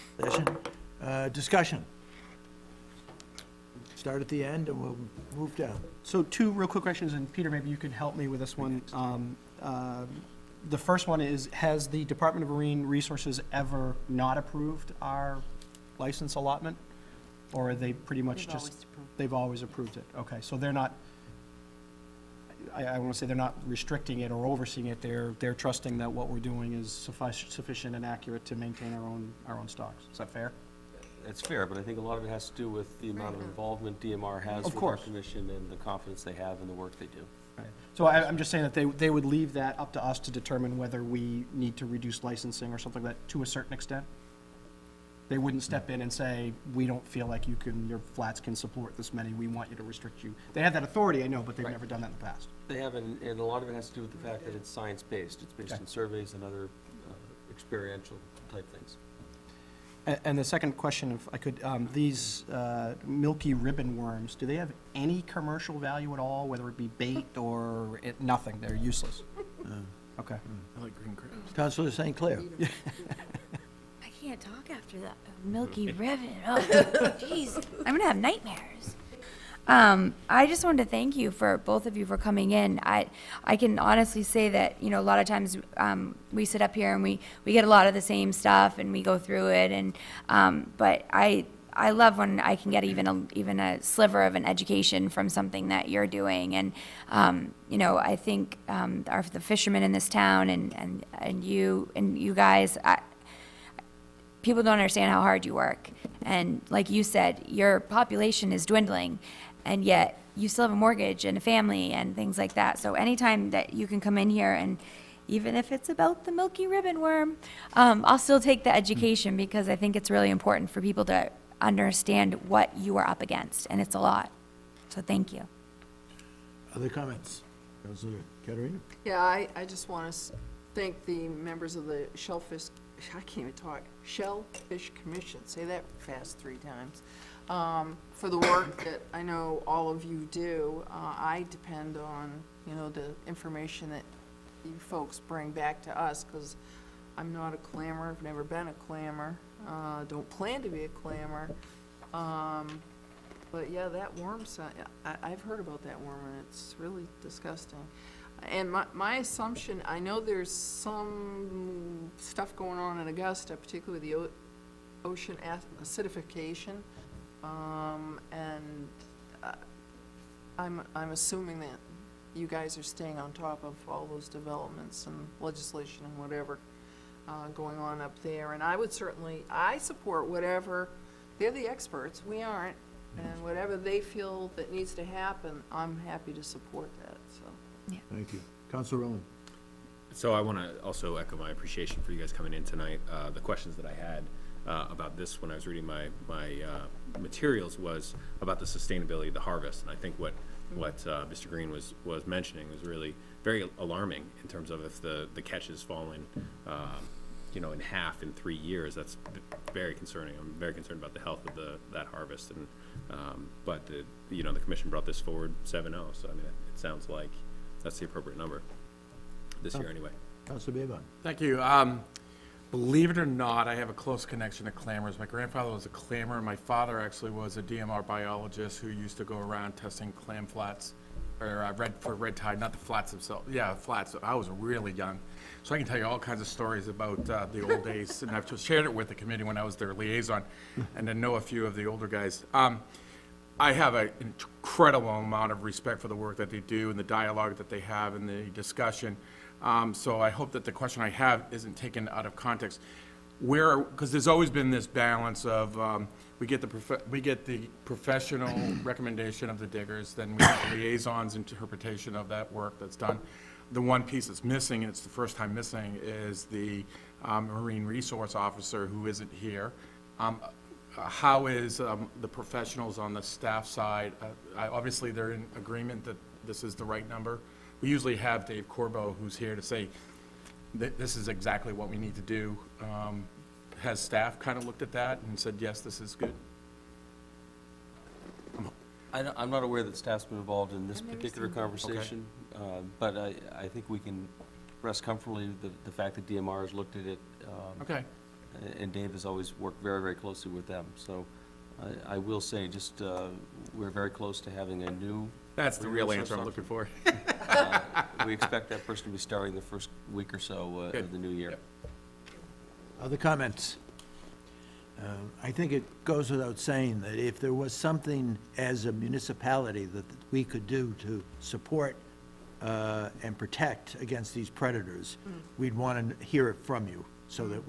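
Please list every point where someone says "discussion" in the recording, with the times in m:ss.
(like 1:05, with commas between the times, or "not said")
0:01, 4:08.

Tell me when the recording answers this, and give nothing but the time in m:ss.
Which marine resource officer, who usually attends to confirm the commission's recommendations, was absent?
4:38.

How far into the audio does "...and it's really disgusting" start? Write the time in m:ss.
2:36.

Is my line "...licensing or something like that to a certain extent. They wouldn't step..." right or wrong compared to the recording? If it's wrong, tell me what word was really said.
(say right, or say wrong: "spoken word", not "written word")
right.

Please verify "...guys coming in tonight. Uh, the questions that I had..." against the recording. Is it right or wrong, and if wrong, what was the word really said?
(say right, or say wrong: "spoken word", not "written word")
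right.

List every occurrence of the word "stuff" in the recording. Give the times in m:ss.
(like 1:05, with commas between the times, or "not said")
1:28, 2:42.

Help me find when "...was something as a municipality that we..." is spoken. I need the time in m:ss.
5:17.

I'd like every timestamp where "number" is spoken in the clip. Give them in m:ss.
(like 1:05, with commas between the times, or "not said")
3:38, 4:37.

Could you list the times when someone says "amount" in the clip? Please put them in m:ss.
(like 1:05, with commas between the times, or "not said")
0:33, 4:05.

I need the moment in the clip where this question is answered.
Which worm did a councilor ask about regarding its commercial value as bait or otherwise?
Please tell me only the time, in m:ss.
1:03.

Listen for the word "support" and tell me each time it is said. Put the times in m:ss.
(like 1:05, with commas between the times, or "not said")
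0:48, 2:59, 3:06, 5:21.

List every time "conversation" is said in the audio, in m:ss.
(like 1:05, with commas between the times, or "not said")
4:51.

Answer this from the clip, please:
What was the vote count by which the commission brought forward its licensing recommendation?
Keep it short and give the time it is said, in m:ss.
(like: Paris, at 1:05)
7-0, at 3:35.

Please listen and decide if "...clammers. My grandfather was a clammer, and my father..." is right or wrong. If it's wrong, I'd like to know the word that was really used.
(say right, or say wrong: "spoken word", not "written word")
right.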